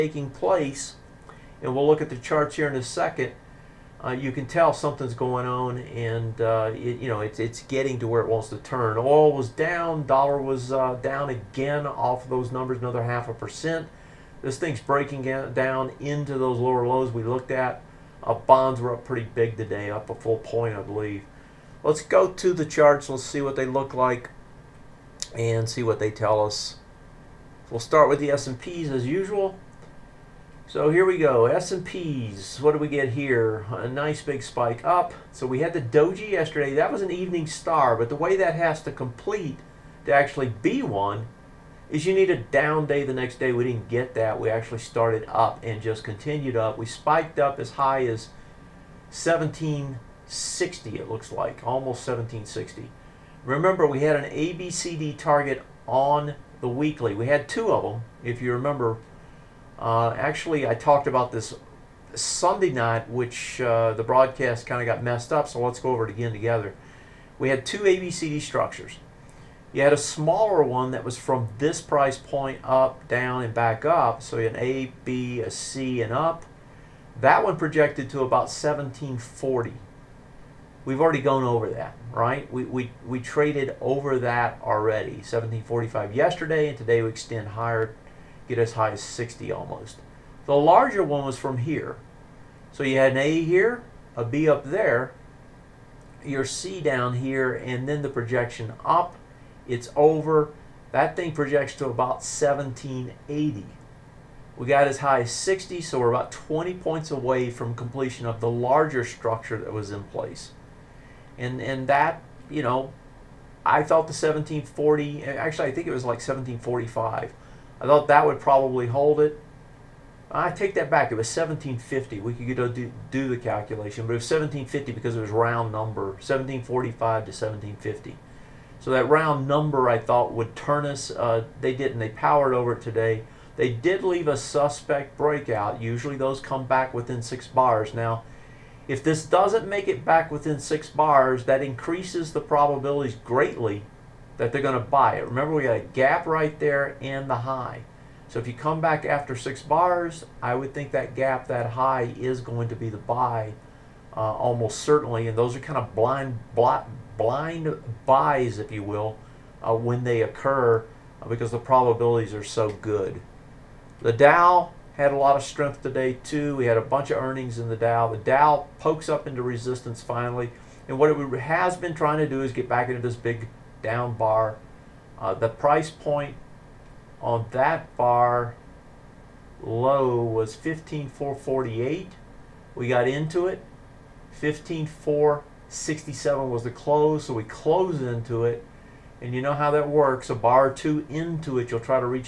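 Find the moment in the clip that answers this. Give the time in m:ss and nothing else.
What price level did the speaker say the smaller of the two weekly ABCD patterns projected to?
1:18.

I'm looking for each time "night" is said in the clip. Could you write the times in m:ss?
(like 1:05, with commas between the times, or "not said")
1:02.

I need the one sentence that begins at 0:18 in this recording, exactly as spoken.
Uh, bonds were up pretty big today, up a full point, I believe.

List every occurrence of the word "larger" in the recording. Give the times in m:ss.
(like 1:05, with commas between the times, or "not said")
1:30, 1:48.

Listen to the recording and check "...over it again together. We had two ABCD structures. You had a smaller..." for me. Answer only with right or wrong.
right.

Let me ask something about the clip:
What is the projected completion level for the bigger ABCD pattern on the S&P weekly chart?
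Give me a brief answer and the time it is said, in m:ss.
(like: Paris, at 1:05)
1780, at 1:41.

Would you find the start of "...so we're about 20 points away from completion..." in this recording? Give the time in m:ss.
1:45.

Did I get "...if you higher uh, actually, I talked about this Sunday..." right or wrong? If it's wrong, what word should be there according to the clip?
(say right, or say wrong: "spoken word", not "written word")
wrong: "remember", not "higher".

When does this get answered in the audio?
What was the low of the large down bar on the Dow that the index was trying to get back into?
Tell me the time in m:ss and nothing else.
3:00.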